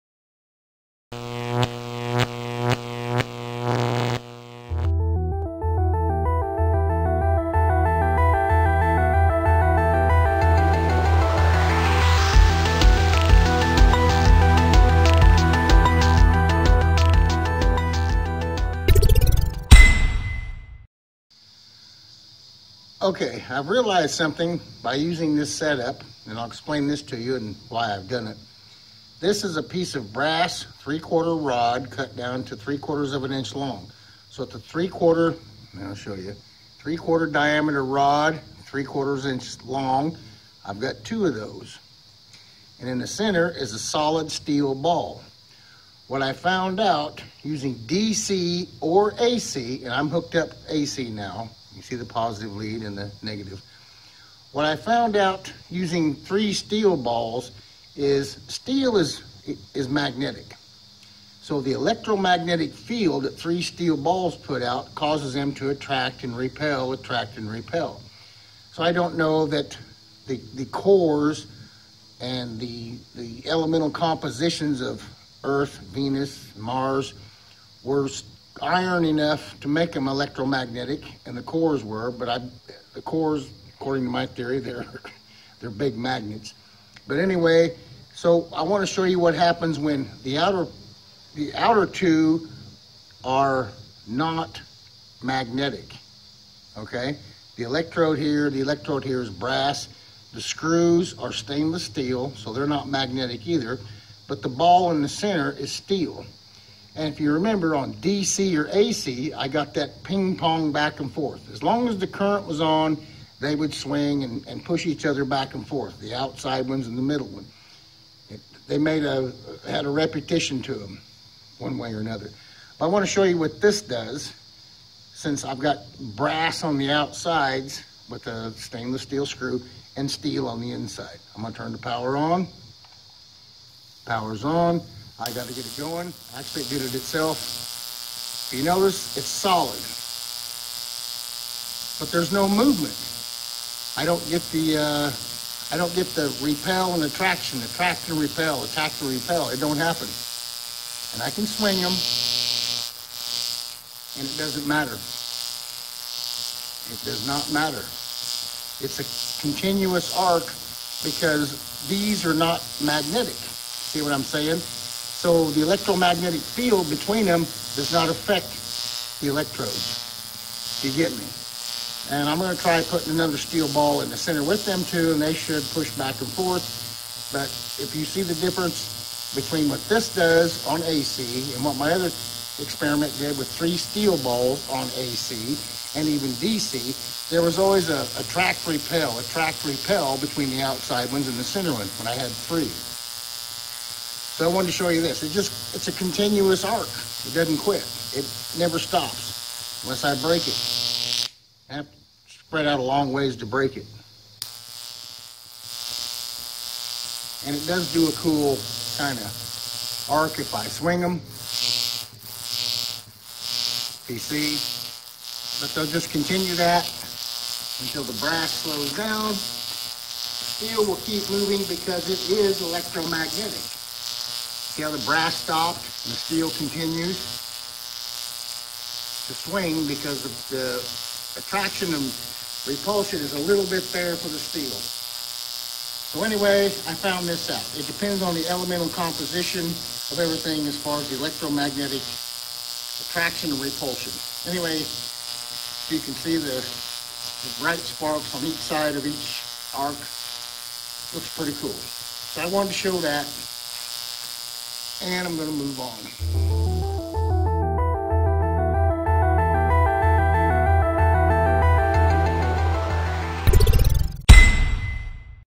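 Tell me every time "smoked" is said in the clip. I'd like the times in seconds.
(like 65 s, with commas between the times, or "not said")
not said.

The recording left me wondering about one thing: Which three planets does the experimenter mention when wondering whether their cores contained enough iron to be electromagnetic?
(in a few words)
Earth, Venus, Mars.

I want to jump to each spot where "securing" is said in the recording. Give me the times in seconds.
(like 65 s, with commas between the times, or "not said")
not said.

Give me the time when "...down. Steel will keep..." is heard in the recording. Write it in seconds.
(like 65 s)
218 s.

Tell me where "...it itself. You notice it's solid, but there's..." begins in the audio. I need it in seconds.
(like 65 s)
136 s.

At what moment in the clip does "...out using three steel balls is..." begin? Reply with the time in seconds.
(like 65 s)
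55 s.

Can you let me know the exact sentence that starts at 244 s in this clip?
Anyway, you can see the, the bright sparks on each side of each arc.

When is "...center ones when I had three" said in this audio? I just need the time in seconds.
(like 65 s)
191 s.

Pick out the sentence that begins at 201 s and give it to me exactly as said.
I have to spread out a long ways to break it.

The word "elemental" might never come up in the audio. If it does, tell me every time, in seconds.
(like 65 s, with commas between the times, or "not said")
73 s, 238 s.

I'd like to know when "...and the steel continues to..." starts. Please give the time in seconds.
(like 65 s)
226 s.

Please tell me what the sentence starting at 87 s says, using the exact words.
But anyway, so I want to show you what happens when the outer, the outer two are not magnetic, okay?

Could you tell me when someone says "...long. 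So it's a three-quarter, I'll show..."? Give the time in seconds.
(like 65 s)
33 s.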